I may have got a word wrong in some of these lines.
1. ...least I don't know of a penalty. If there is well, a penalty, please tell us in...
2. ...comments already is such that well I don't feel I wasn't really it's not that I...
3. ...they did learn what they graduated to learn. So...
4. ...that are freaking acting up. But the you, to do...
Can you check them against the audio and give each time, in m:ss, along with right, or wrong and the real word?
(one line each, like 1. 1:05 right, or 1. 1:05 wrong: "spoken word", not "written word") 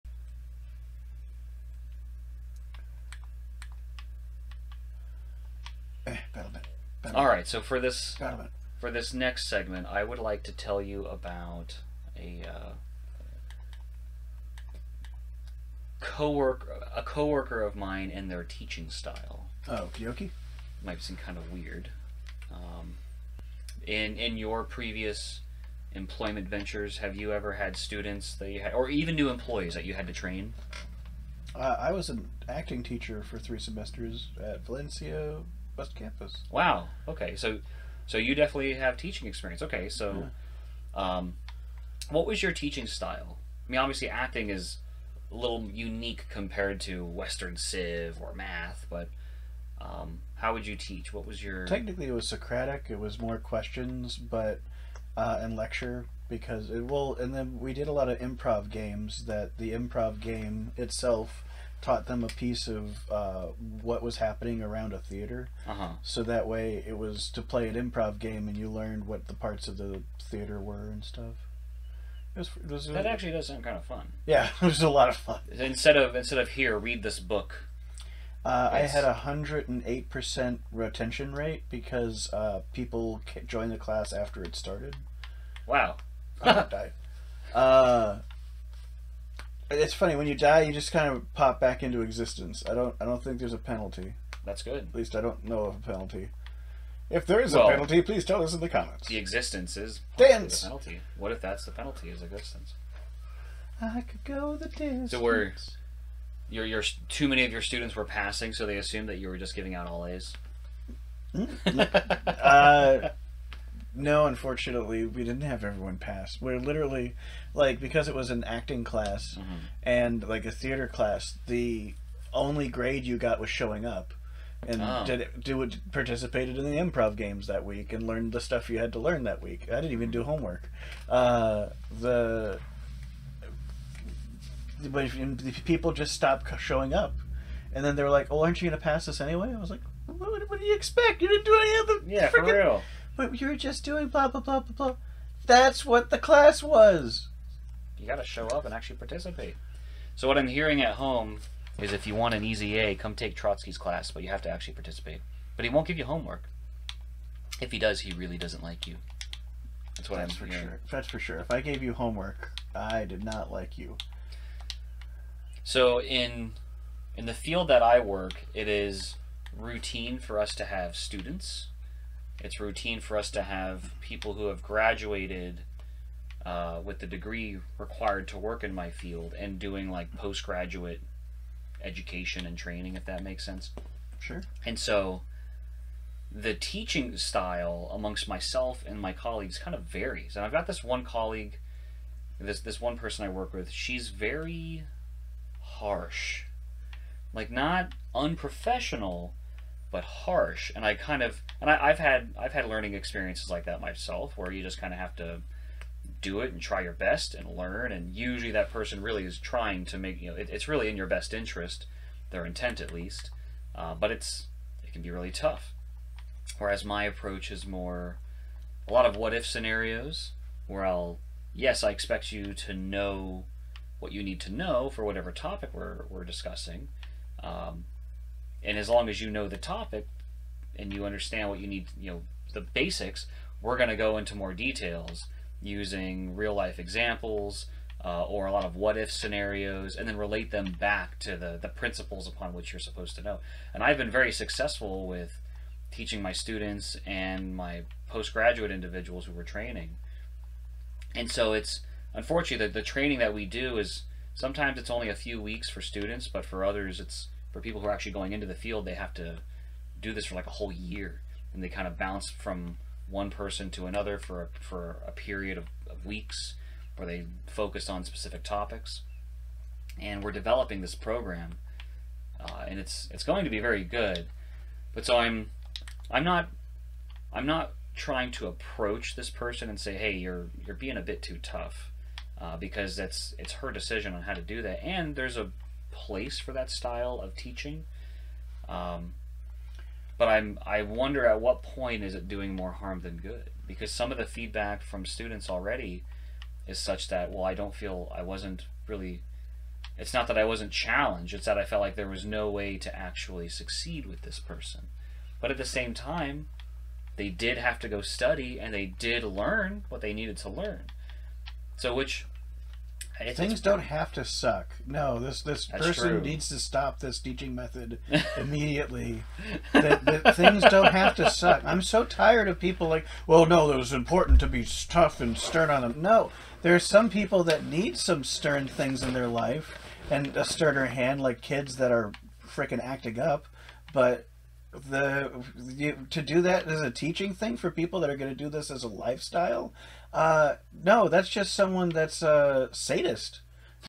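1. 1:34 right
2. 4:55 wrong: "students", not "comments"
3. 5:08 wrong: "needed", not "graduated"
4. 5:31 right.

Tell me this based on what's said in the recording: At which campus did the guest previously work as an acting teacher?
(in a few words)
Valencia West Campus.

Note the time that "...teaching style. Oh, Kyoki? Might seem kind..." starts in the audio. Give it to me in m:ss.
0:18.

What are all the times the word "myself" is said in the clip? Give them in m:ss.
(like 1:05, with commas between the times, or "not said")
3:08, 3:23.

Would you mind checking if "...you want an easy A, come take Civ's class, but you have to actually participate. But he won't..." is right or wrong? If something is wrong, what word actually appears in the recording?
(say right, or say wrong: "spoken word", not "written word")
wrong: "Trotsky", not "Civ".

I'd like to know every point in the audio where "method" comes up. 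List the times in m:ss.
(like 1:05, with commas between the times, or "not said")
5:17.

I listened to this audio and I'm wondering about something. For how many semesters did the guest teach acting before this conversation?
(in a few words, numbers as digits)
3.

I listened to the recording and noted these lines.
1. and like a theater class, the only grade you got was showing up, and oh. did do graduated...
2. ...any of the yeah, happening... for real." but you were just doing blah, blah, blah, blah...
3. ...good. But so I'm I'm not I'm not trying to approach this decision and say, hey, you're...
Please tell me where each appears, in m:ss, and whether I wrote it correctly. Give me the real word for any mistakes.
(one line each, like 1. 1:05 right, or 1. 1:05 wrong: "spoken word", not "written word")
1. 1:59 wrong: "participated", not "graduated"
2. 2:21 wrong: "freaking", not "happening"
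3. 4:33 wrong: "person", not "decision".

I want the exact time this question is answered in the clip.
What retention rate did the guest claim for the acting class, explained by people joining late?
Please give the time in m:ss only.
1:19.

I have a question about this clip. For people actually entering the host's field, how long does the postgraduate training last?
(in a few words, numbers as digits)
A whole year.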